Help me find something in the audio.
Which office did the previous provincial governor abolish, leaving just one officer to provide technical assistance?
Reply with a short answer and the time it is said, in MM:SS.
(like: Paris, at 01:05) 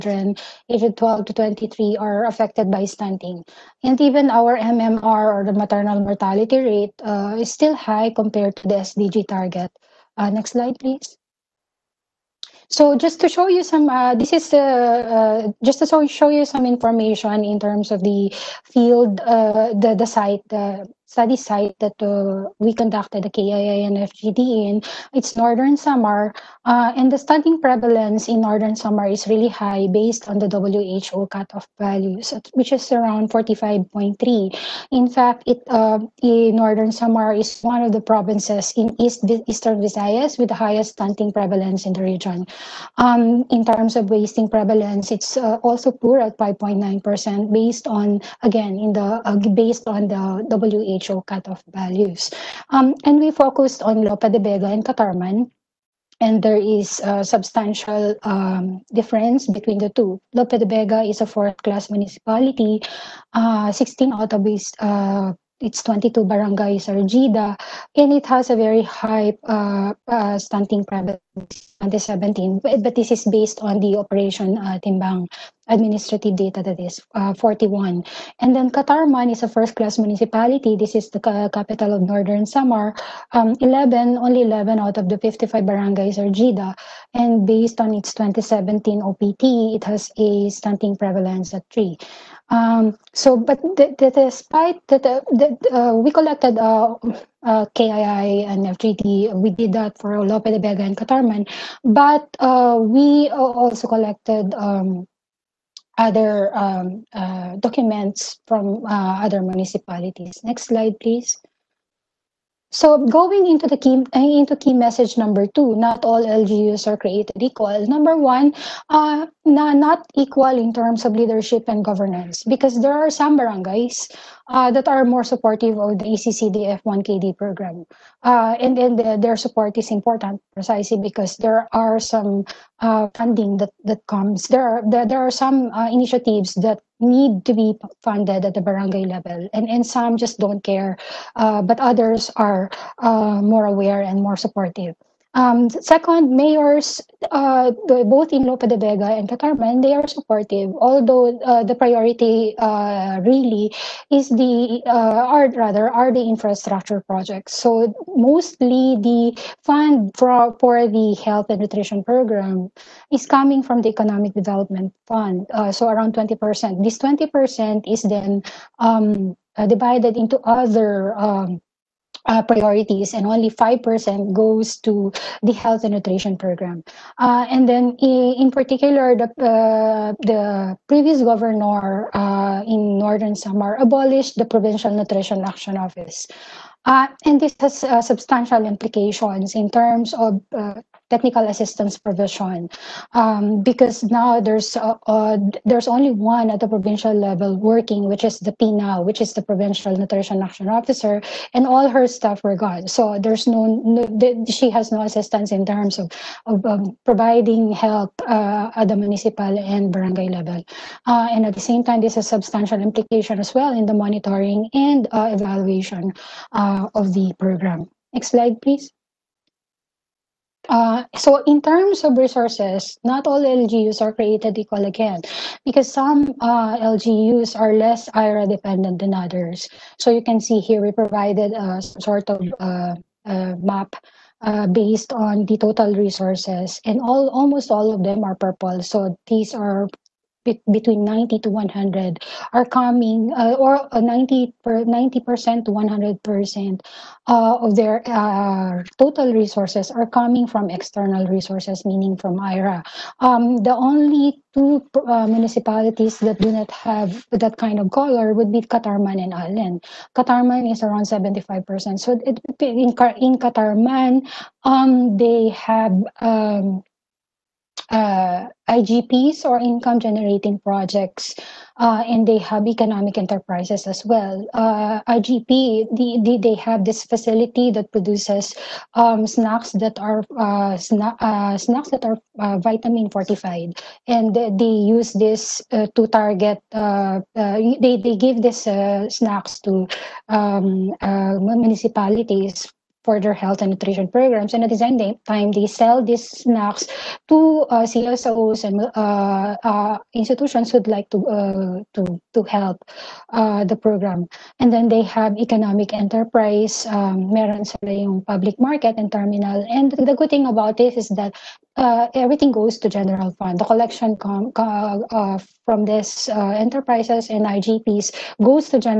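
Provincial Nutrition Action Office, at 03:04.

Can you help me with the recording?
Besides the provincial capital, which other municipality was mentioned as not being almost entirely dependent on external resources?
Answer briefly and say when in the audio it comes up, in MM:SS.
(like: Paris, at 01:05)
Allen, at 04:19.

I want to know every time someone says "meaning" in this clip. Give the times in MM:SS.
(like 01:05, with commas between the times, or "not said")
04:11.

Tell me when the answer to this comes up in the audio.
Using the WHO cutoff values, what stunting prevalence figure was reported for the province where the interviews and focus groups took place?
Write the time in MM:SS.
00:33.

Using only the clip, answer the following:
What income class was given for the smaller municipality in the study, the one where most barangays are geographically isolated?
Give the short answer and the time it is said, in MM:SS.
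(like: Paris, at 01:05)
fourth class, at 01:01.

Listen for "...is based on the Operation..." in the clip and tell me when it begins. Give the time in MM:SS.
01:13.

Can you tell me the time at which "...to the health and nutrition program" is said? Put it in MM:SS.
02:54.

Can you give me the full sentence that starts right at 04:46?
they they give these snacks to um, municipalities for their health and nutrition programs.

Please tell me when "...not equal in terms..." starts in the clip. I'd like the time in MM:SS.
01:59.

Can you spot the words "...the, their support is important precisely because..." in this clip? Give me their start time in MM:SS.
02:08.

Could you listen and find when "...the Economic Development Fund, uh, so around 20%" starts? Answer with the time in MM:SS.
02:43.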